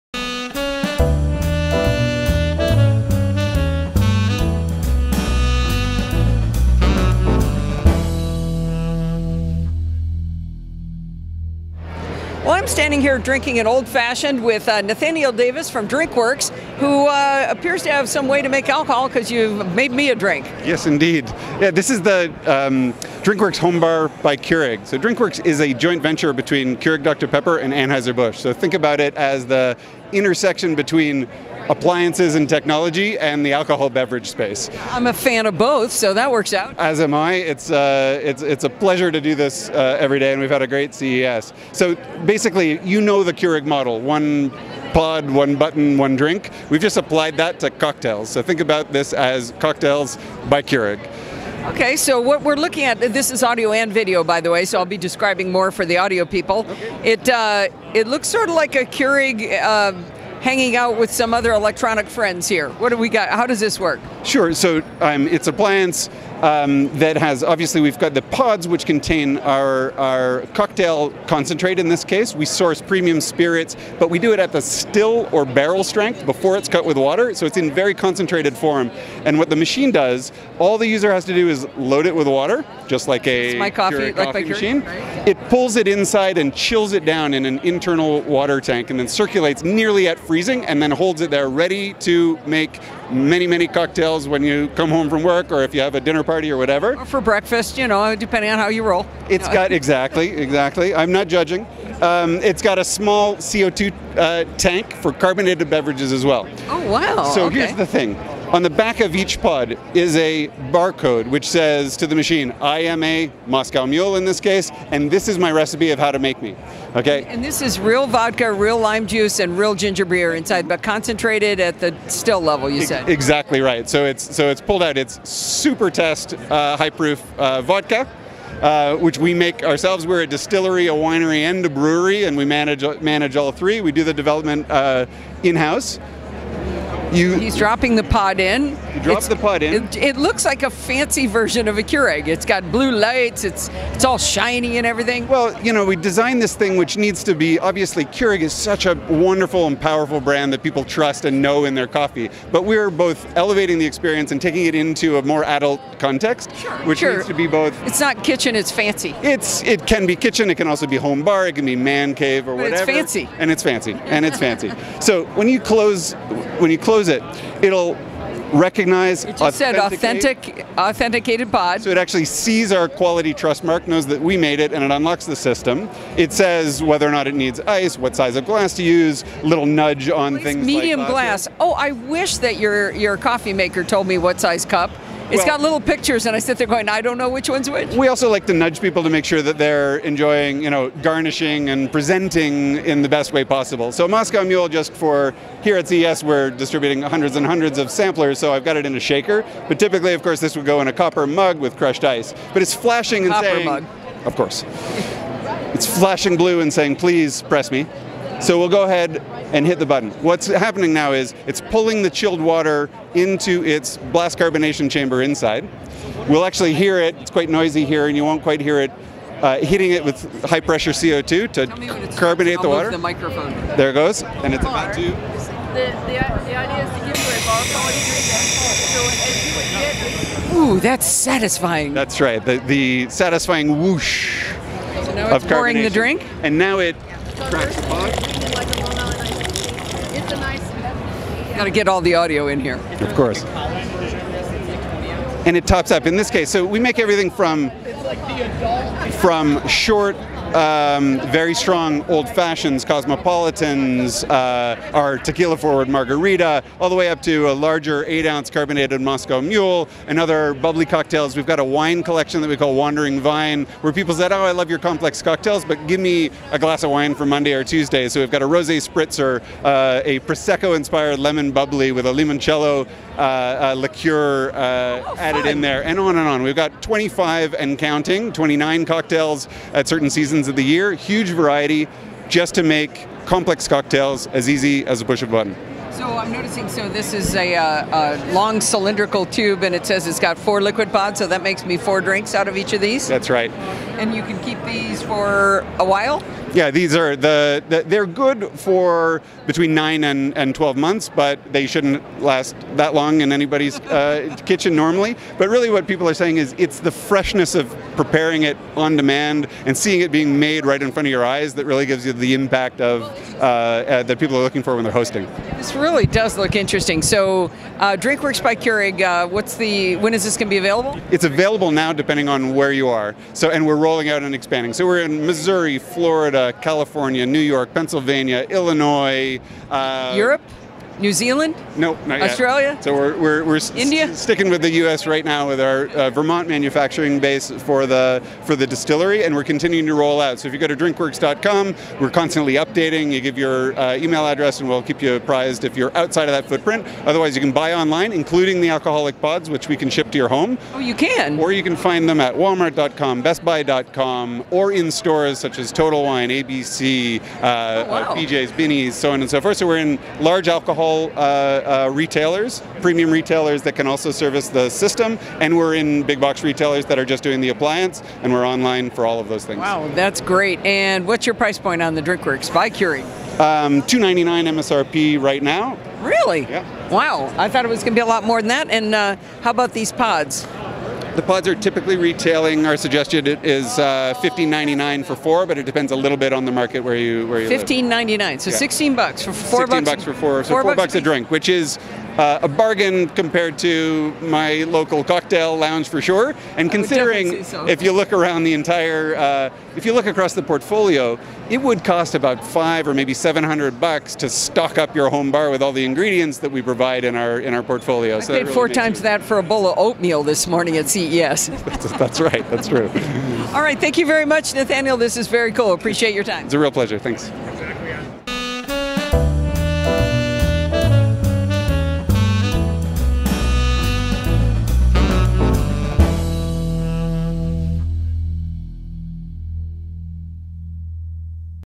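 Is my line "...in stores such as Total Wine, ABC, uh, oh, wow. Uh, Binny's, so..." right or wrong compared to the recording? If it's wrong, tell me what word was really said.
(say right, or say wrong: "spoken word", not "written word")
right.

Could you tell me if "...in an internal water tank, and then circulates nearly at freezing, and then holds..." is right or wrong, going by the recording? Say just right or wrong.
right.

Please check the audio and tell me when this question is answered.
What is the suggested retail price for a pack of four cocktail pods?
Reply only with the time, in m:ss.
6:24.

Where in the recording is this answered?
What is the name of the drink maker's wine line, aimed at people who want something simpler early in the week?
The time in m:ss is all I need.
4:22.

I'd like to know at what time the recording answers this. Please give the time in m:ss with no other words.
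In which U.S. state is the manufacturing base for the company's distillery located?
5:36.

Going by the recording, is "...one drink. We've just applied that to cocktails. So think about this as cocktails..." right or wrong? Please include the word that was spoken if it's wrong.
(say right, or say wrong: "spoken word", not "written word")
right.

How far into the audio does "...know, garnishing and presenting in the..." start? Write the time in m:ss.
3:10.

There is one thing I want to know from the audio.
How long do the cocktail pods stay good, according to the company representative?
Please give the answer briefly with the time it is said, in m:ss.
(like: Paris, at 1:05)
9 to 12 months, at 4:59.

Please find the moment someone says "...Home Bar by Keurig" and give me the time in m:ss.
0:23.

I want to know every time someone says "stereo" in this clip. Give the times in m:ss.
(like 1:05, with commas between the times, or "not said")
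not said.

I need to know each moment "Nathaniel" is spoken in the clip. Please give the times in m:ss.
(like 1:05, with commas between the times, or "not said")
0:14, 6:54.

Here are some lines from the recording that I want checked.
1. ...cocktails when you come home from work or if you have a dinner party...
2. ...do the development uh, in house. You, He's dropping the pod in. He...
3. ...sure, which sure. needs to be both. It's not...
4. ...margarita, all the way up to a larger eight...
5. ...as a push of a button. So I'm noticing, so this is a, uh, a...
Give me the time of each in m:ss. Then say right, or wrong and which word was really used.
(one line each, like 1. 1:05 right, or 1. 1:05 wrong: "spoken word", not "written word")
1. 1:34 right
2. 2:13 right
3. 2:36 right
4. 4:15 right
5. 4:44 right.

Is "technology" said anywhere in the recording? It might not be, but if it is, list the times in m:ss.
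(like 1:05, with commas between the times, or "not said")
0:32.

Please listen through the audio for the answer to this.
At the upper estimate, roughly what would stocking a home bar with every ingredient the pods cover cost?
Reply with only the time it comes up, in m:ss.
6:43.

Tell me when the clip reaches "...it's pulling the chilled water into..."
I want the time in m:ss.
3:31.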